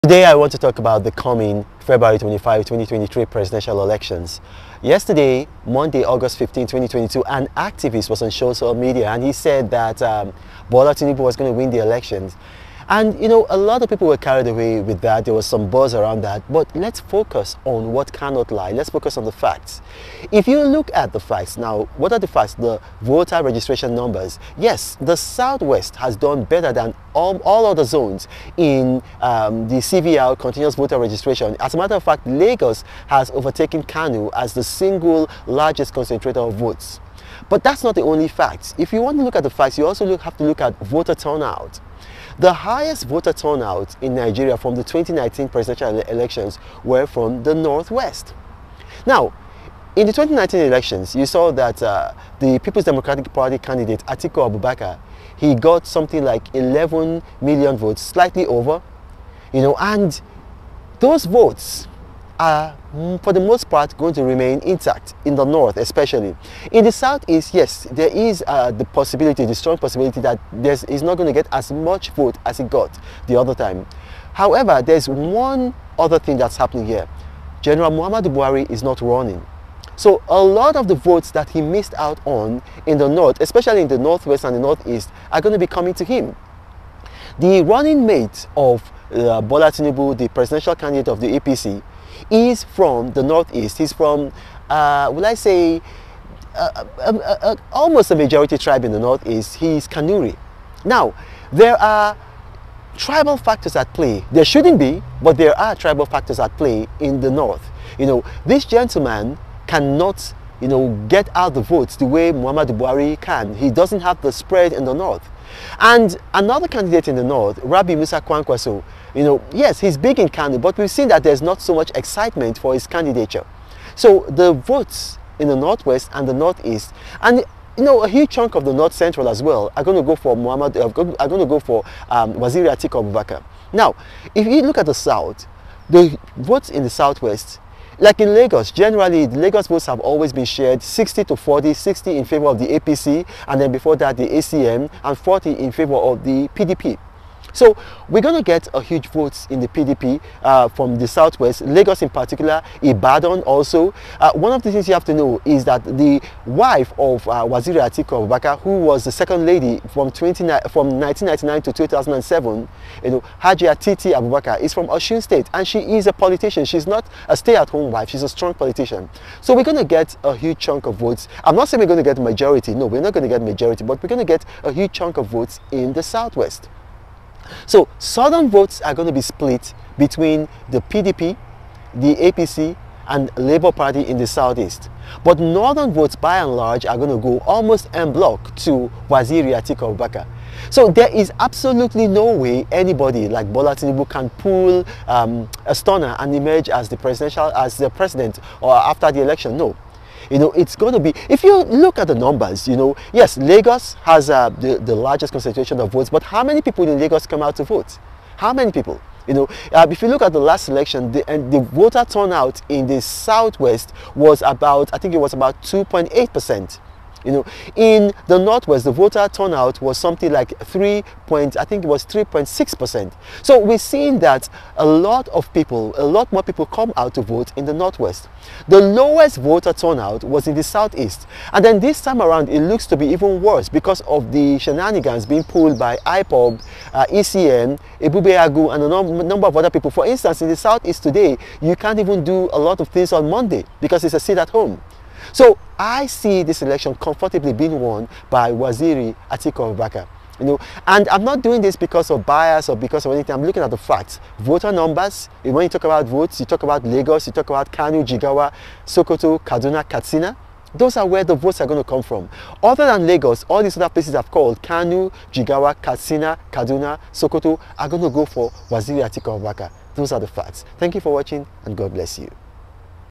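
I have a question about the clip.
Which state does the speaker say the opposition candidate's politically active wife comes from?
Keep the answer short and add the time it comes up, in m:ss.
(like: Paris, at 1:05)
Osun State, at 2:44.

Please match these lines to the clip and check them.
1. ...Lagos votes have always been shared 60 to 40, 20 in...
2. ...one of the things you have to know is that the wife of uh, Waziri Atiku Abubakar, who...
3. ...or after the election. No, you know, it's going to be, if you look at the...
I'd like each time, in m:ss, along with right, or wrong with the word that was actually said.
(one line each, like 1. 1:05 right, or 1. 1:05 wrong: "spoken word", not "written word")
1. 2:19 wrong: "60", not "20"
2. 2:34 right
3. 3:18 right.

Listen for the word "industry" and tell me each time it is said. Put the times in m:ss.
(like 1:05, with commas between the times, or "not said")
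not said.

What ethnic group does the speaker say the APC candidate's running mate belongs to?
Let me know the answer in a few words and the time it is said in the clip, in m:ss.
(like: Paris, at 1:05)
Kanuri, at 1:39.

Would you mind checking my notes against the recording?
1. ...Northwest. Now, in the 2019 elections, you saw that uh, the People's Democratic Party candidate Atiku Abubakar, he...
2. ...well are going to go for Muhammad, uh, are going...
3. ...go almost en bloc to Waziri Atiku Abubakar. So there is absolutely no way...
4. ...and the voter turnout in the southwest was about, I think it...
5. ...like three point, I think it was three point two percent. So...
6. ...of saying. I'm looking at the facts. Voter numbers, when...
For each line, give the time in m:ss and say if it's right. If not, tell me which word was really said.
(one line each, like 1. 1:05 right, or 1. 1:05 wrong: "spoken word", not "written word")
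1. 0:47 right
2. 2:09 right
3. 3:07 right
4. 3:31 right
5. 3:40 wrong: "six", not "two"
6. 4:13 wrong: "anything", not "saying".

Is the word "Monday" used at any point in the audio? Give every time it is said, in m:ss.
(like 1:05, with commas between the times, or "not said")
0:05, 4:03.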